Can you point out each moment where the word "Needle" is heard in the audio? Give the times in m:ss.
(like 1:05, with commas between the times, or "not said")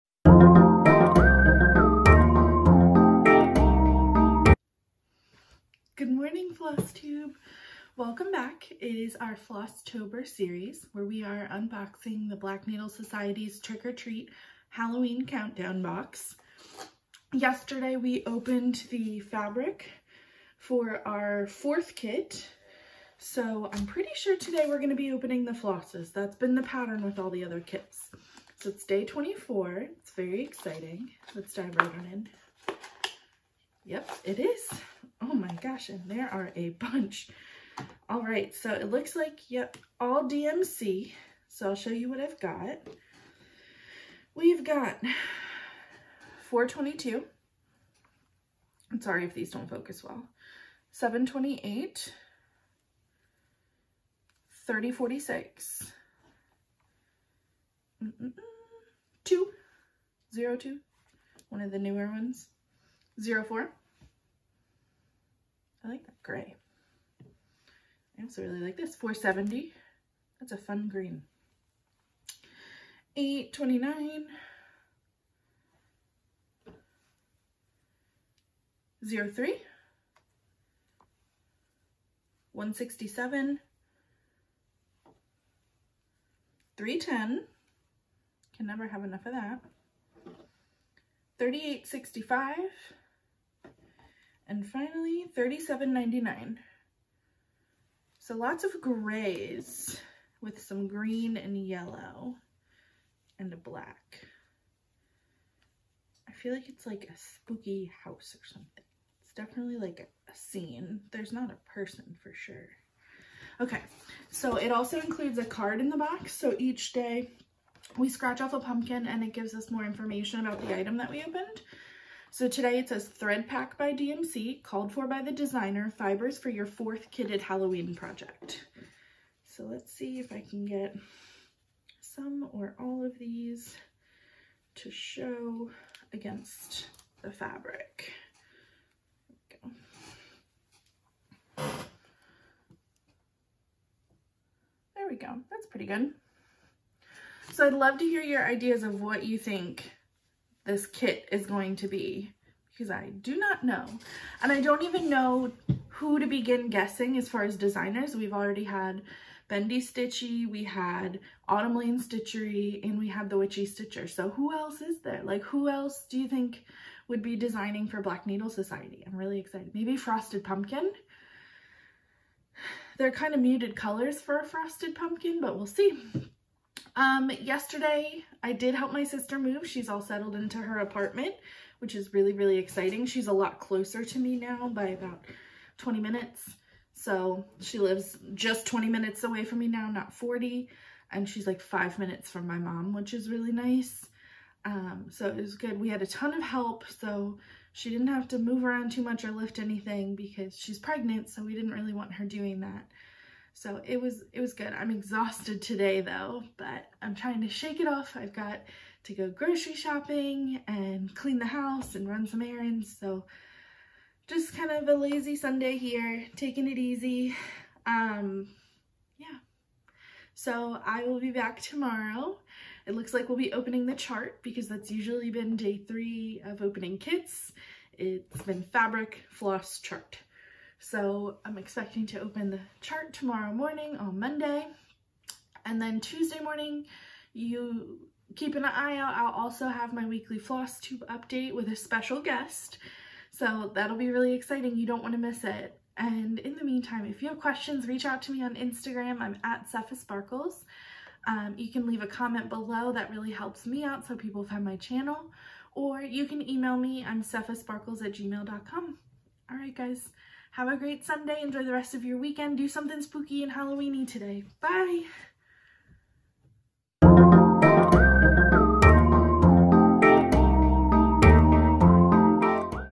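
0:12, 2:48.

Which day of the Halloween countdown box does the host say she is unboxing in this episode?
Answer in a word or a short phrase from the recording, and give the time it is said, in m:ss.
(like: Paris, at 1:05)
24, at 0:28.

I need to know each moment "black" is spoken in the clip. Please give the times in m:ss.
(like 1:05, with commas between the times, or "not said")
0:12, 1:43, 2:48.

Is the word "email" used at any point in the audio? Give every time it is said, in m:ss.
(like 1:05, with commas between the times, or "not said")
4:16.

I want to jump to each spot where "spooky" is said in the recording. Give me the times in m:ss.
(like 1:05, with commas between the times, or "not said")
1:47, 4:23.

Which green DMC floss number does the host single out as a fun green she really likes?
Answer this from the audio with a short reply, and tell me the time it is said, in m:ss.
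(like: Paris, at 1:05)
470, at 1:08.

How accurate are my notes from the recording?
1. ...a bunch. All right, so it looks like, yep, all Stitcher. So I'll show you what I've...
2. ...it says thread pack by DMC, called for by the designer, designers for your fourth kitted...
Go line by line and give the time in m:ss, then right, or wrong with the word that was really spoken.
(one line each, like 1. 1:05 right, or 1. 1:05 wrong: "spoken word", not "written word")
1. 0:36 wrong: "DMC", not "Stitcher"
2. 2:02 wrong: "fibers", not "designers".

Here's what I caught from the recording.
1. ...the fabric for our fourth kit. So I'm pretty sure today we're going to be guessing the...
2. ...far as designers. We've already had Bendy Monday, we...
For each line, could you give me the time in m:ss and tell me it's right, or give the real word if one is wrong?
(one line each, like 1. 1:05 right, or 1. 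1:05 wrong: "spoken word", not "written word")
1. 0:18 wrong: "opening", not "guessing"
2. 2:37 wrong: "Stitchy", not "Monday".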